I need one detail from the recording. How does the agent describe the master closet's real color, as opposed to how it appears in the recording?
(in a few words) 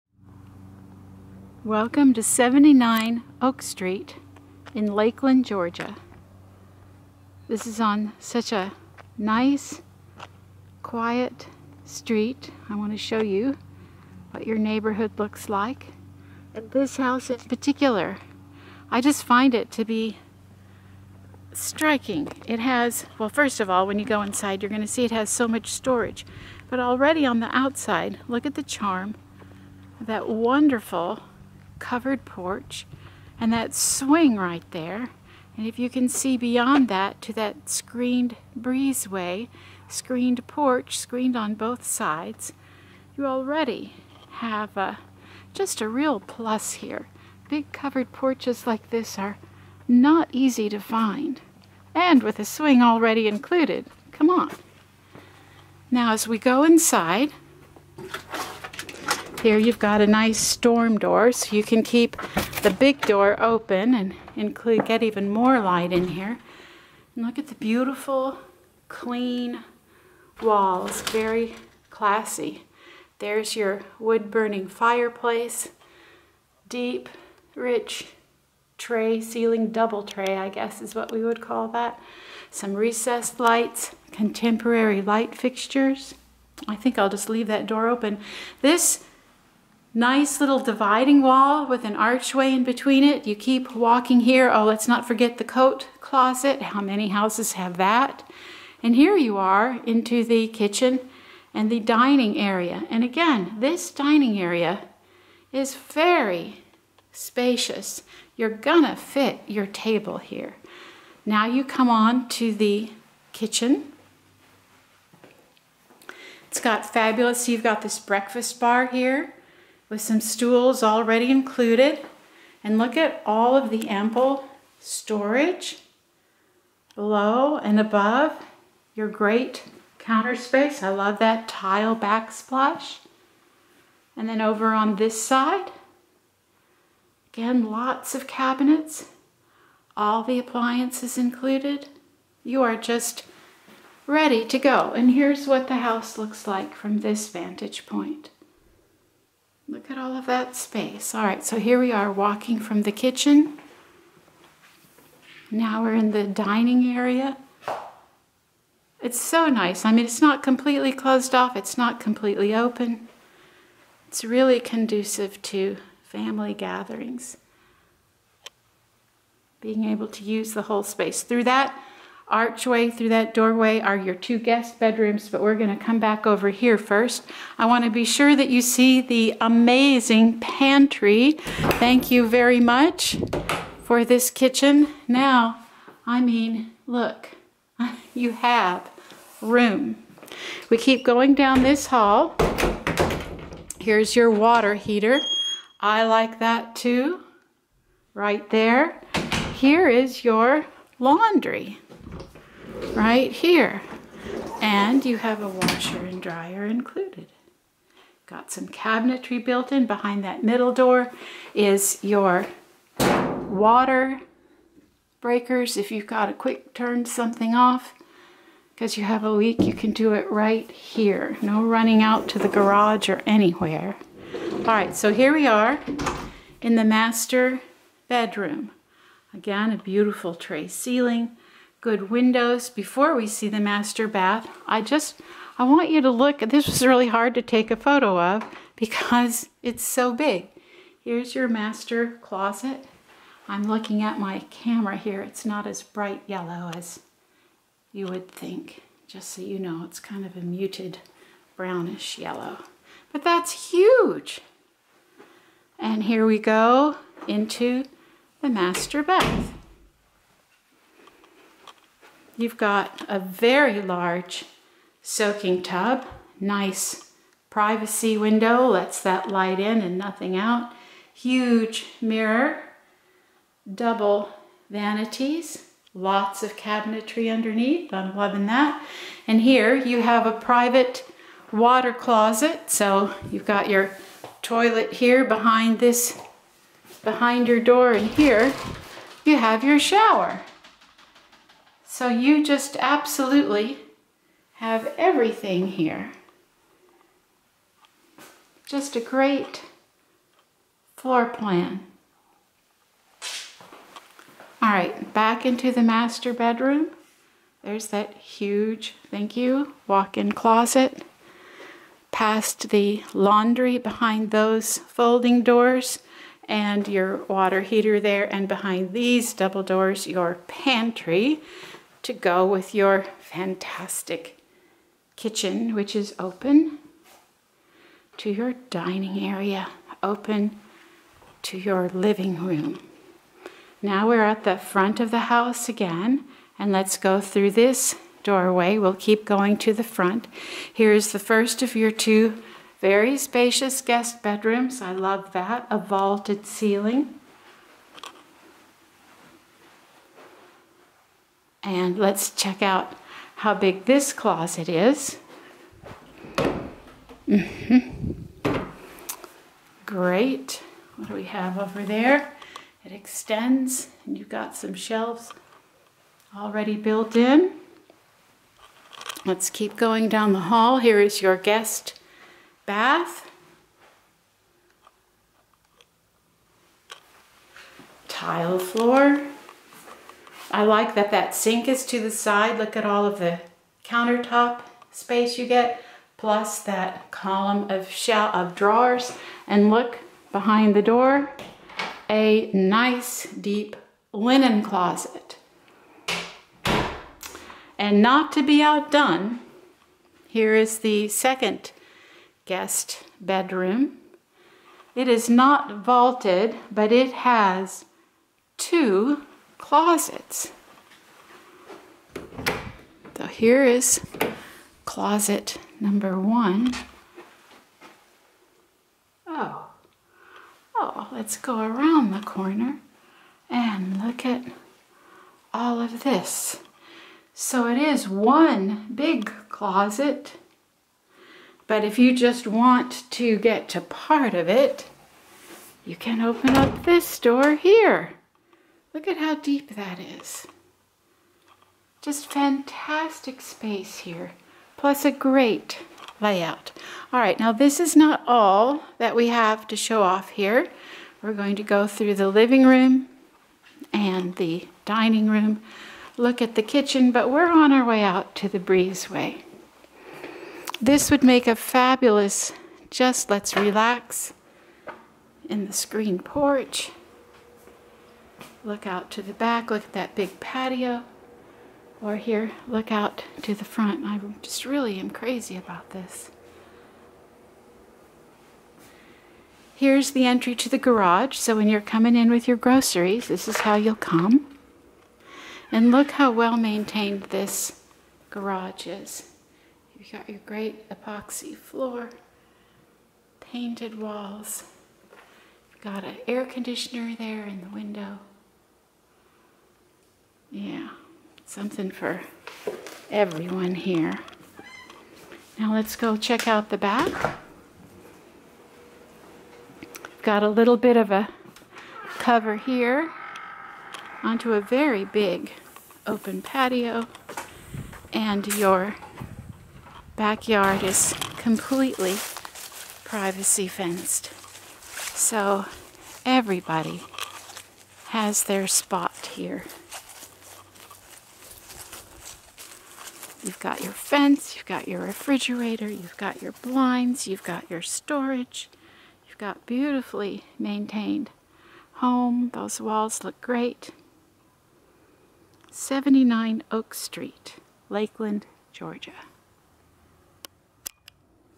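Muted brownish yellow.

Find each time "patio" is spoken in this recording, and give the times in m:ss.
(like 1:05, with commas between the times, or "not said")
7:50, 8:36.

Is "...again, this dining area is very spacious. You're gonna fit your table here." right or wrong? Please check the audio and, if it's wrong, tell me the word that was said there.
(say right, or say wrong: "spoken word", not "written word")
right.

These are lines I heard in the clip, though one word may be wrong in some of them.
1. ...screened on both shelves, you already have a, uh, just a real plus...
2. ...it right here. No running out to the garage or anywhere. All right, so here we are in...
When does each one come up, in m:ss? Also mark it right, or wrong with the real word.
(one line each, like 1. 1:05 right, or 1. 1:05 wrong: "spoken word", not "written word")
1. 0:40 wrong: "sides", not "shelves"
2. 3:40 right.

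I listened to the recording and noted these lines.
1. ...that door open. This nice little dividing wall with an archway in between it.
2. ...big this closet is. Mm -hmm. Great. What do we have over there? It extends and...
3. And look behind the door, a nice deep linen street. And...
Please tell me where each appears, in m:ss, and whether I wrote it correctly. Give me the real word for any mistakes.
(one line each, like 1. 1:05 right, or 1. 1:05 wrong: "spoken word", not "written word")
1. 1:27 right
2. 5:53 right
3. 6:29 wrong: "closet", not "street".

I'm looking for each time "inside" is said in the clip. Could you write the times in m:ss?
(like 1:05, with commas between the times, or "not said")
0:24, 0:56.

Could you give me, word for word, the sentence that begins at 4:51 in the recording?
So you just absolutely have everything here.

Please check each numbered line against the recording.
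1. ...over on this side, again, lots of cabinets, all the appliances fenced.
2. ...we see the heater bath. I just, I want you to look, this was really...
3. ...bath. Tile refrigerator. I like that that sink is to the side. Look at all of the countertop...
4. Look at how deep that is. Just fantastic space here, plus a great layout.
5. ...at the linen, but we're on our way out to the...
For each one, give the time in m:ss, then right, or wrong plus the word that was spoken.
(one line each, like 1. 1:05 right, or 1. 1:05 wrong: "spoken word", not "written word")
1. 2:14 wrong: "included", not "fenced"
2. 3:53 wrong: "master", not "heater"
3. 6:12 wrong: "floor", not "refrigerator"
4. 7:18 right
5. 7:36 wrong: "kitchen", not "linen".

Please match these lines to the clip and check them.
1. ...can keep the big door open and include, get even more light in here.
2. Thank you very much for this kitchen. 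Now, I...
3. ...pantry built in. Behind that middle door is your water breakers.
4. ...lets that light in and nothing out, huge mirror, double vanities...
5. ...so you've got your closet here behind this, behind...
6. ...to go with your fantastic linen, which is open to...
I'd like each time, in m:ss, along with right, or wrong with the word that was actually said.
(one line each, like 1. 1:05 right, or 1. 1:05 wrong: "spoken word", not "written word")
1. 1:01 right
2. 3:01 right
3. 3:28 wrong: "cabinetry", not "pantry"
4. 4:28 right
5. 4:42 wrong: "toilet", not "closet"
6. 5:22 wrong: "kitchen", not "linen".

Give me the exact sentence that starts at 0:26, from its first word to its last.
But already on the outside, look at the charm that wonderful covered porch and that swing right there.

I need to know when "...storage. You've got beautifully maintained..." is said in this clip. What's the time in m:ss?
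8:57.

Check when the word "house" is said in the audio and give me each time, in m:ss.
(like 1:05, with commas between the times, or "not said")
0:16, 1:37, 2:25, 5:35.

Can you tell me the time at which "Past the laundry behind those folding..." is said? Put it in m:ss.
5:12.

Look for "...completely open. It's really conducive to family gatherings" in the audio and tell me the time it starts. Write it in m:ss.
2:42.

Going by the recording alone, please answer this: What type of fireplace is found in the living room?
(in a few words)
Wood-burning.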